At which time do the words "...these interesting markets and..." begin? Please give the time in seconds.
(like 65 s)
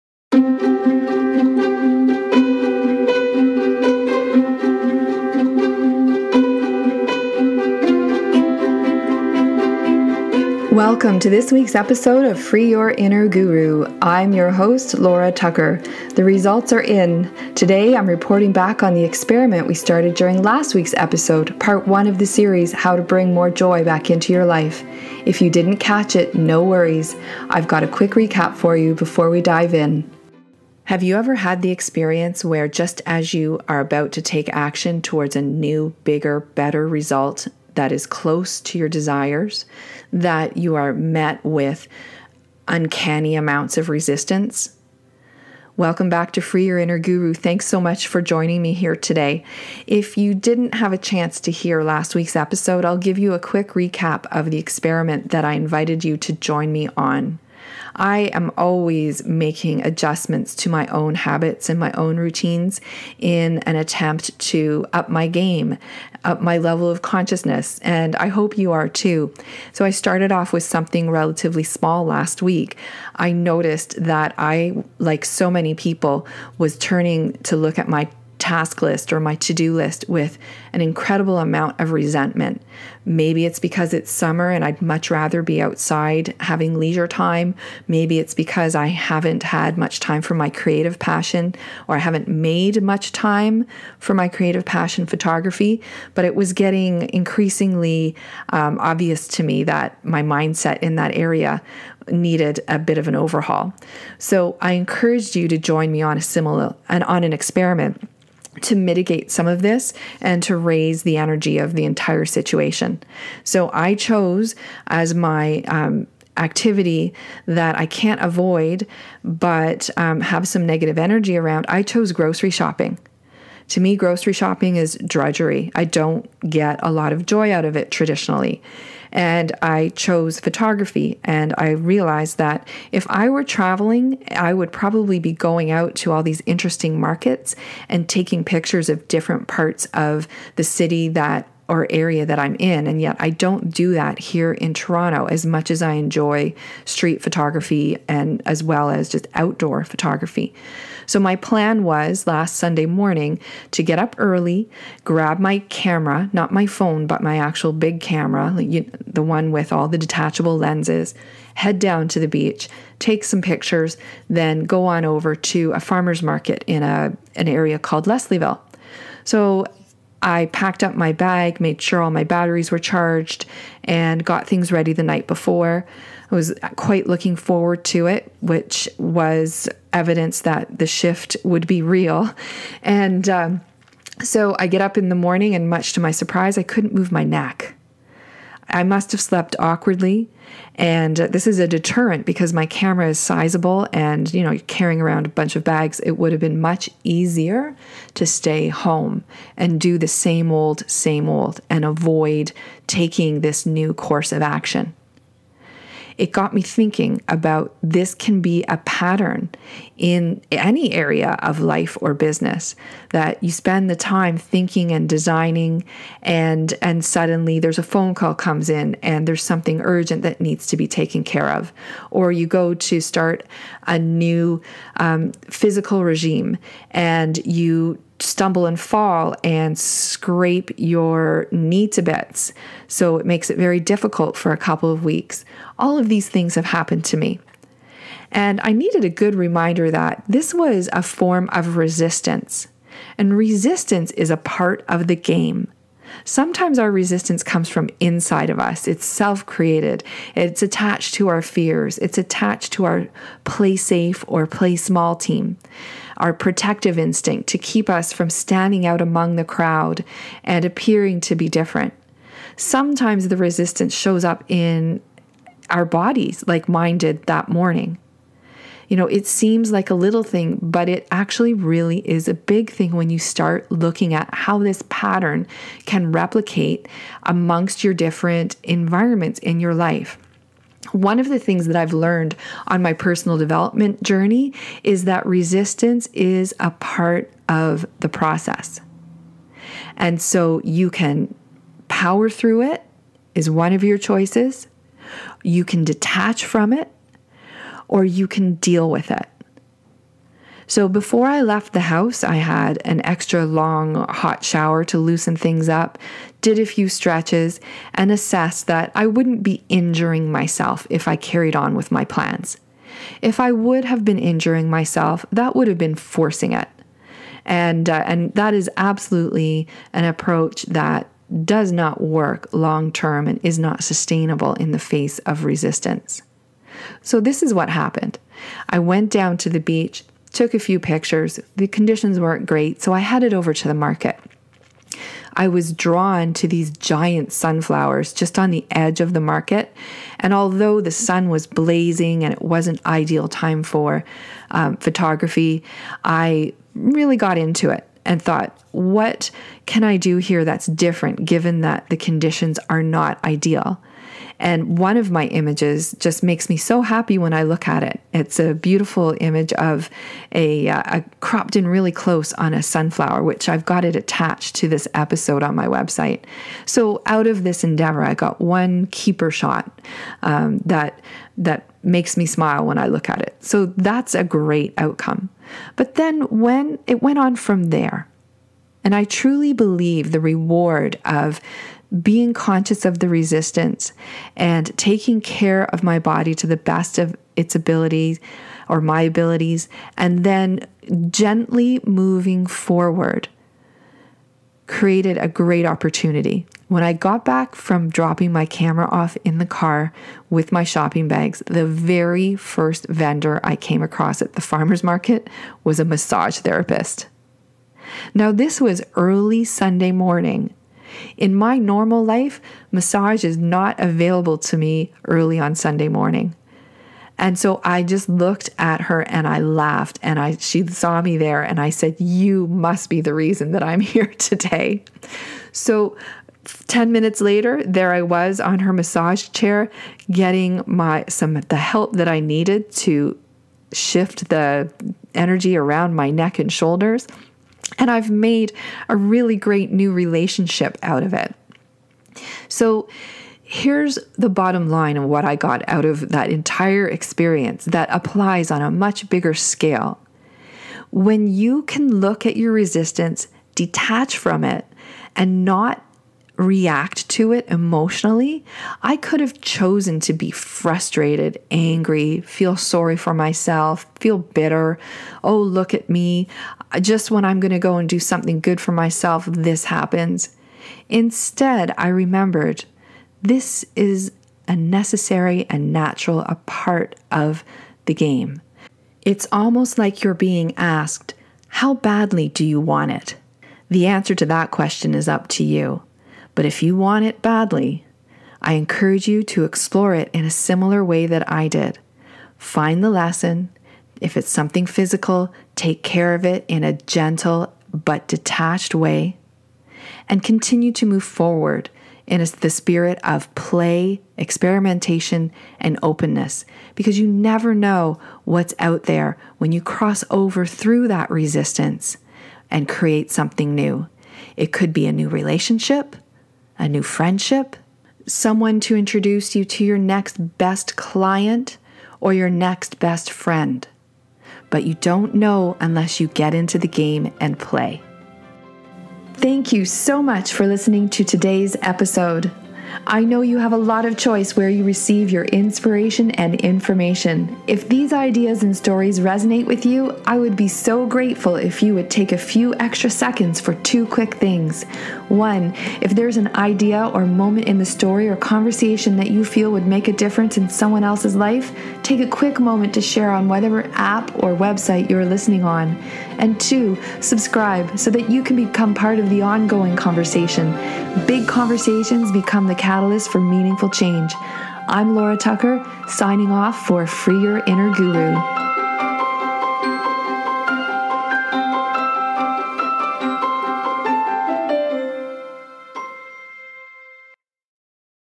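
136 s.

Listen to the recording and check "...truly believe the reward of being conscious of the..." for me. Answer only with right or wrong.
right.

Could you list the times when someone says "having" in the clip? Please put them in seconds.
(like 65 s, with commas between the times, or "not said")
86 s.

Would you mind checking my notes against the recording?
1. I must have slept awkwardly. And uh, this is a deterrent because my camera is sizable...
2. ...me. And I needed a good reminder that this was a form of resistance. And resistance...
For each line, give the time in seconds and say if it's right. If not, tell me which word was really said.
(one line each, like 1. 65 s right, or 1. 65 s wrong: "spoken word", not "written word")
1. 188 s right
2. 237 s right.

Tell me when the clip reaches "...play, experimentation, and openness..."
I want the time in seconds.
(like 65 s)
503 s.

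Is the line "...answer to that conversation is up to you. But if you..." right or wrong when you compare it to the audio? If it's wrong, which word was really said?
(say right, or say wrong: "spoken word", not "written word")
wrong: "question", not "conversation".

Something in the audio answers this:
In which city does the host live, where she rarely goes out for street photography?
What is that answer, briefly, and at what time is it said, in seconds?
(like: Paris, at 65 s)
Toronto, at 144 s.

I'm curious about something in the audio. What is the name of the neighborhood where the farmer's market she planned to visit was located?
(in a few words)
Leslieville.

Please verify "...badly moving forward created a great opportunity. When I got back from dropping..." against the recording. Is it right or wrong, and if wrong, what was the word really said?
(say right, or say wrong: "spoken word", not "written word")
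wrong: "gently", not "badly".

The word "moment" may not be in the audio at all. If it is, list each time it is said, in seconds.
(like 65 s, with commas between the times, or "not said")
547 s, 552 s.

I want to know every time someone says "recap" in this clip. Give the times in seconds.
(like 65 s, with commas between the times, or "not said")
28 s, 53 s.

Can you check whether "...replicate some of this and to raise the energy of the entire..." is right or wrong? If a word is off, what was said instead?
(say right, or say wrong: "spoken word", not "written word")
wrong: "mitigate", not "replicate".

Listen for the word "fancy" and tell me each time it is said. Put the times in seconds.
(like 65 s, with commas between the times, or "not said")
not said.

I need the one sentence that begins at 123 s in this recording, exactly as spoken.
To me, grocery shopping is drudgery.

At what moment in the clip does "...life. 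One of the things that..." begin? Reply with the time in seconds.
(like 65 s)
279 s.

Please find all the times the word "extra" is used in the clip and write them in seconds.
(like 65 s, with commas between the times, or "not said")
303 s, 542 s.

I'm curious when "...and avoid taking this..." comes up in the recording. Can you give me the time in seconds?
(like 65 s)
201 s.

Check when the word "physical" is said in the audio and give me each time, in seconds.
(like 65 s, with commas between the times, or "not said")
225 s, 494 s.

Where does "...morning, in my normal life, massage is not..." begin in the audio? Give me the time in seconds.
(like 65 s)
409 s.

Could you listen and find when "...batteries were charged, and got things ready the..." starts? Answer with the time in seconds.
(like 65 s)
172 s.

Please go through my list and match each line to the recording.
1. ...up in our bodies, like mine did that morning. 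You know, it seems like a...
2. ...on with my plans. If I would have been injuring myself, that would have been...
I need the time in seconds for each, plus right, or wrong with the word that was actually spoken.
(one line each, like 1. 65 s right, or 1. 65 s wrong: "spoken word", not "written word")
1. 264 s right
2. 311 s right.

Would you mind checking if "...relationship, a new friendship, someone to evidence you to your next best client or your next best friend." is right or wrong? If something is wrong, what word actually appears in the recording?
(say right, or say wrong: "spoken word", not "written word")
wrong: "introduce", not "evidence".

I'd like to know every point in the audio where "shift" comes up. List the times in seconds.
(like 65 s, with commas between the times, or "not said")
180 s, 433 s.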